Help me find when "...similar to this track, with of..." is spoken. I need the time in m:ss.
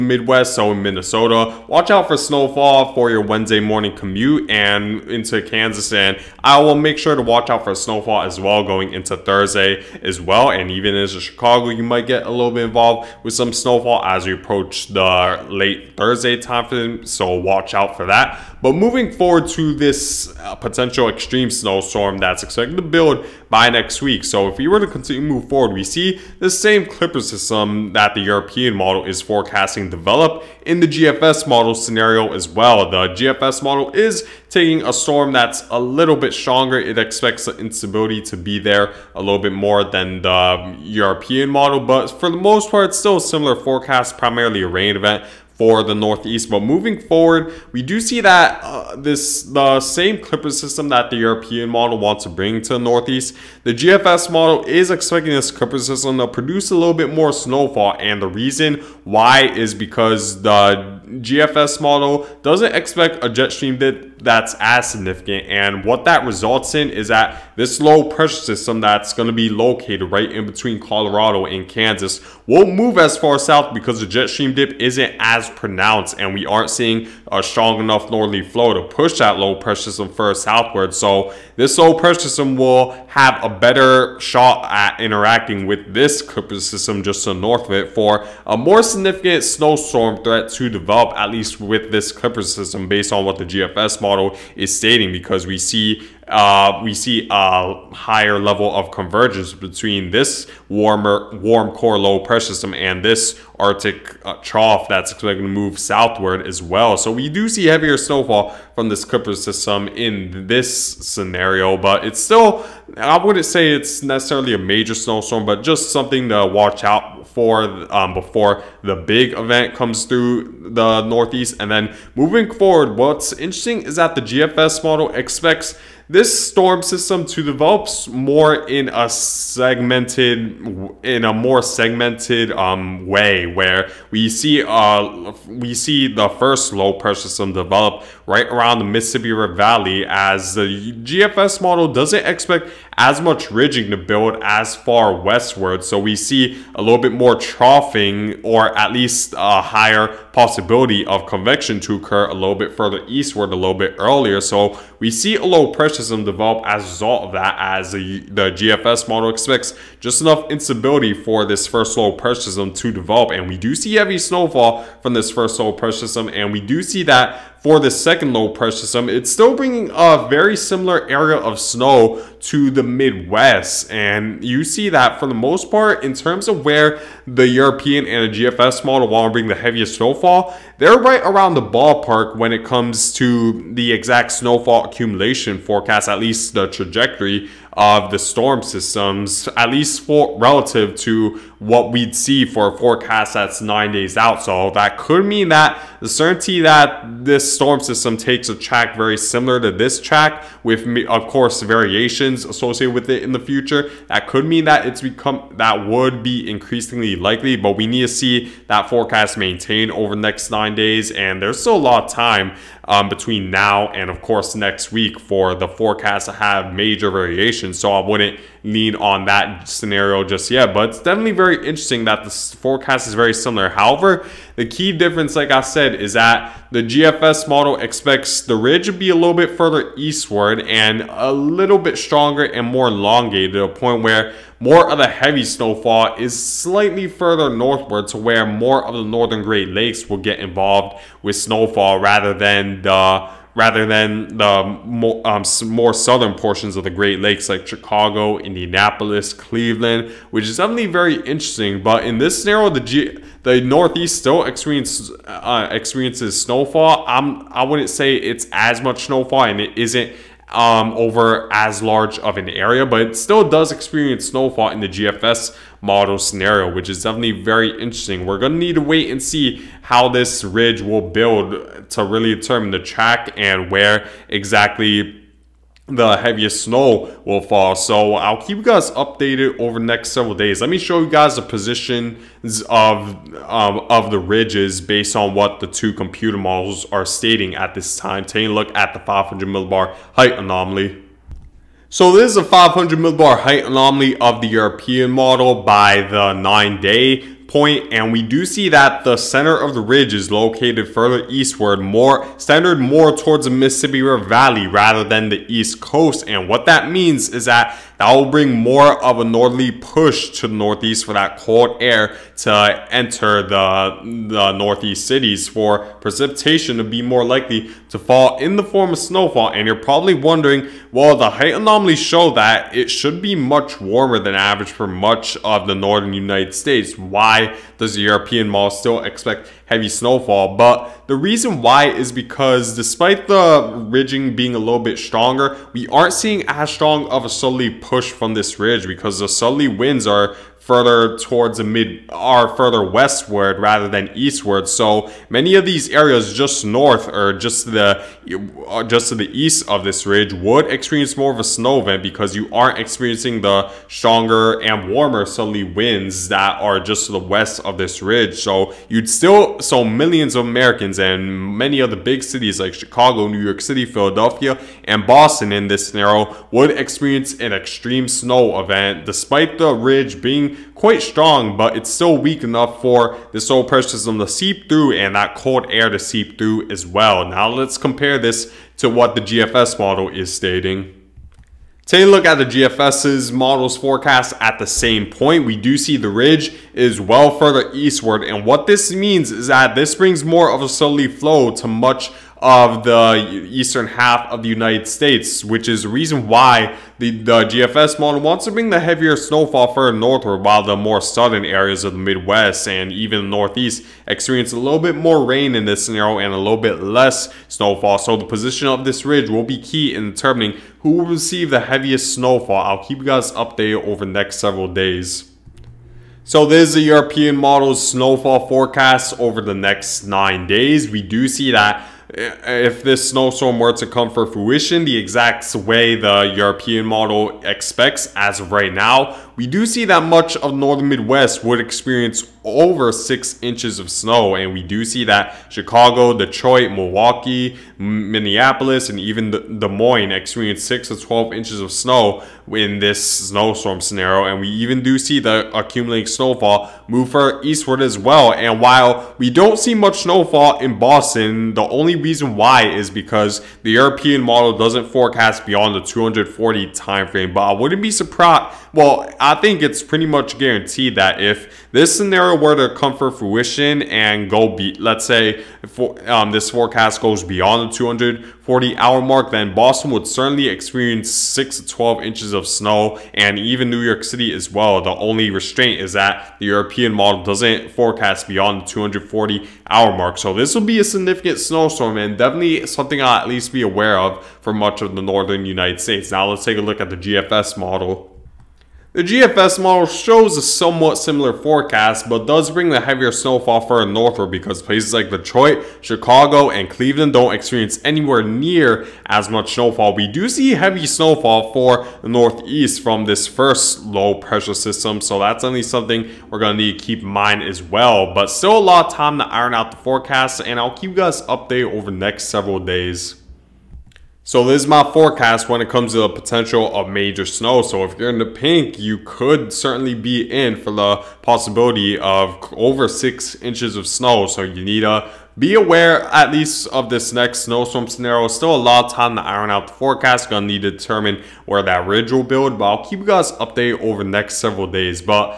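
3:19.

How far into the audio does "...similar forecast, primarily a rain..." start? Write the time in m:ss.
0:43.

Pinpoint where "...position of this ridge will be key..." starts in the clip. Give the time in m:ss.
6:48.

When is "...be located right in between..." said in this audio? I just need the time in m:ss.
1:09.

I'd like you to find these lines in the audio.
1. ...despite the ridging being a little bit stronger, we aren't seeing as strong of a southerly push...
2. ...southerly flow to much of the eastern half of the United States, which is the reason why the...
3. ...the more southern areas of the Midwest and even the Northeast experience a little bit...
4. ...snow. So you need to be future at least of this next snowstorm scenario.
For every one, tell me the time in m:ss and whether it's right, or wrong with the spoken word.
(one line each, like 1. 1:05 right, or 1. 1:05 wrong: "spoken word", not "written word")
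1. 5:32 right
2. 6:30 right
3. 6:40 right
4. 8:43 wrong: "aware", not "future".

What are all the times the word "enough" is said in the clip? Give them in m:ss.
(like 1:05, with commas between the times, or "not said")
1:17, 2:40, 6:12.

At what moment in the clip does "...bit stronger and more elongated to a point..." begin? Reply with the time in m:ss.
3:51.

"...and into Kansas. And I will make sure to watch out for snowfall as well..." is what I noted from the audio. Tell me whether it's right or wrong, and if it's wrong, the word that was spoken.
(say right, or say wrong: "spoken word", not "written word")
right.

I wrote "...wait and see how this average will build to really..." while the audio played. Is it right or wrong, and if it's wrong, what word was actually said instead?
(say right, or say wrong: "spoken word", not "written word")
wrong: "ridge", not "average".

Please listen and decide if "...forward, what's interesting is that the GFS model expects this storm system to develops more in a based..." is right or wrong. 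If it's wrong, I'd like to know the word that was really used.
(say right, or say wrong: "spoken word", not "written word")
wrong: "segmented", not "based".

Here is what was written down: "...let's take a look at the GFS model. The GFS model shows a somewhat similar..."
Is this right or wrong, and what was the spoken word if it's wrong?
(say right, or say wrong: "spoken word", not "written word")
right.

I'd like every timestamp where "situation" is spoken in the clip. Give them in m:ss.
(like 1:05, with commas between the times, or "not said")
3:37.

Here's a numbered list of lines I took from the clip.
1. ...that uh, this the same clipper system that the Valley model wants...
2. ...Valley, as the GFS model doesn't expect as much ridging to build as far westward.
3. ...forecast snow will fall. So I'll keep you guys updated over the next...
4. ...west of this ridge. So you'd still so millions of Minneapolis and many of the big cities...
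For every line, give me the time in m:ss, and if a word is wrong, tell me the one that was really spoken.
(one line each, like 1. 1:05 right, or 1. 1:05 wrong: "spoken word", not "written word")
1. 0:48 wrong: "European", not "Valley"
2. 2:19 right
3. 4:36 wrong: "heaviest", not "forecast"
4. 5:57 wrong: "Americans", not "Minneapolis".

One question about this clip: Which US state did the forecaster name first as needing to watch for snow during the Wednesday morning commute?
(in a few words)
Minnesota.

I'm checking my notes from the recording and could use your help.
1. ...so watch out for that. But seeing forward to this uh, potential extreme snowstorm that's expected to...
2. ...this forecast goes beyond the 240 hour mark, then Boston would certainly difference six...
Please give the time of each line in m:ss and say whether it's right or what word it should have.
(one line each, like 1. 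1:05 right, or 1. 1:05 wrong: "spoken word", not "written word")
1. 0:17 wrong: "moving", not "seeing"
2. 7:46 wrong: "experience", not "difference".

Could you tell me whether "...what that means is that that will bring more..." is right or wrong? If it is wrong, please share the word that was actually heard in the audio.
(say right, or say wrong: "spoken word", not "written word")
right.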